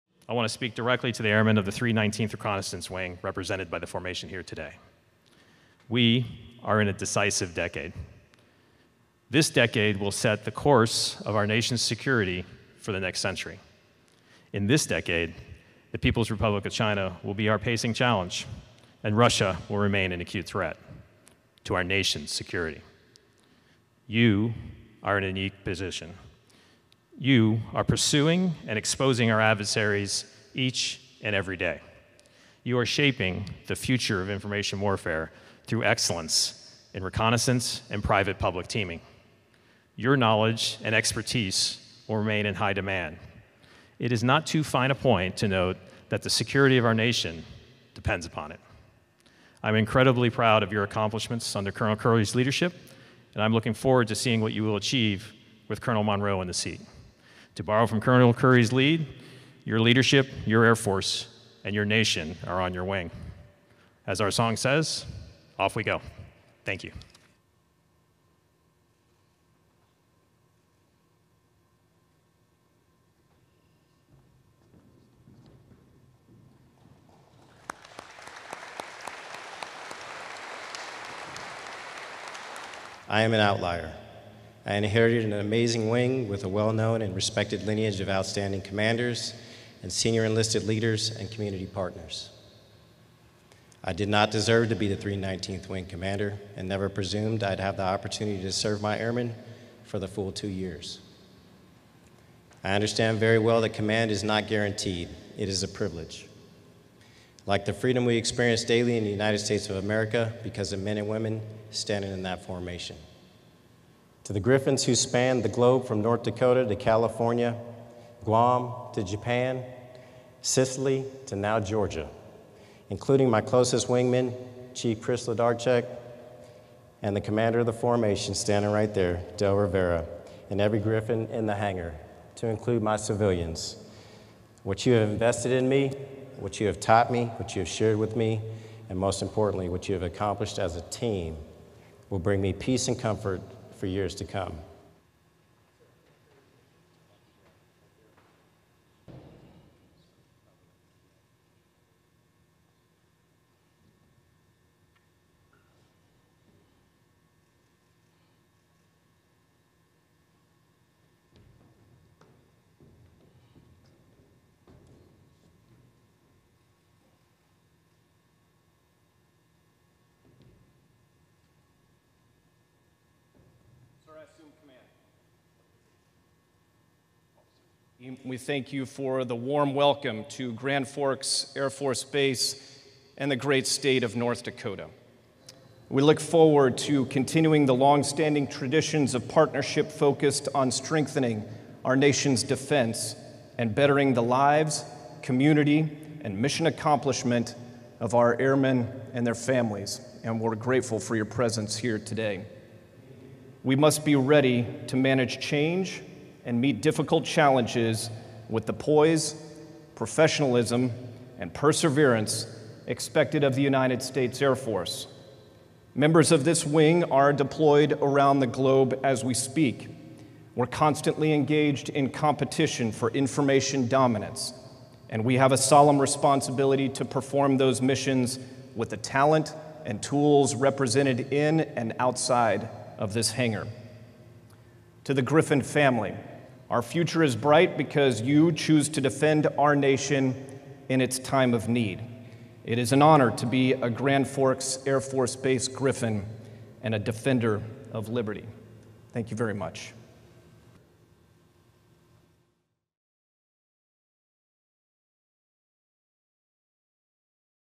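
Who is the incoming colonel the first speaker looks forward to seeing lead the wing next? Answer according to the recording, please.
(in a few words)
Colonel Monroe.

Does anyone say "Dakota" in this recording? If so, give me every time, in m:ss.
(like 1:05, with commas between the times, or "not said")
1:56, 3:04.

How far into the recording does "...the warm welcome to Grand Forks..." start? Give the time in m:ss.
2:59.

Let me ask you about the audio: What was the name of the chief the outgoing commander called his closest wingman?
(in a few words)
Chris Ladarchek.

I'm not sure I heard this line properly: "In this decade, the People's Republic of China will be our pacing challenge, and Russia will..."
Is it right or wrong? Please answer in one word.
right.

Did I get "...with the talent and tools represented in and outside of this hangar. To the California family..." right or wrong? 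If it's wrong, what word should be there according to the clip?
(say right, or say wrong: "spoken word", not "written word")
wrong: "Griffin", not "California".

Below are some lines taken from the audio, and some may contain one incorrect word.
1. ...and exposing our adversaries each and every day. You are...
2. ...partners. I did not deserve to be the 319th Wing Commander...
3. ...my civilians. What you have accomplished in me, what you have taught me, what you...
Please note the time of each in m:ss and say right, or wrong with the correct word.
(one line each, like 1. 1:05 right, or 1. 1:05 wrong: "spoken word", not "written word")
1. 0:28 right
2. 1:31 right
3. 2:12 wrong: "invested", not "accomplished".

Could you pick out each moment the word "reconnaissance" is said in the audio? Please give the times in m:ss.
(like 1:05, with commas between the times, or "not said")
0:02, 0:37.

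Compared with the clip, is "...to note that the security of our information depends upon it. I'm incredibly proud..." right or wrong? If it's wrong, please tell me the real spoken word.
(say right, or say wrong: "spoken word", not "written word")
wrong: "nation", not "information".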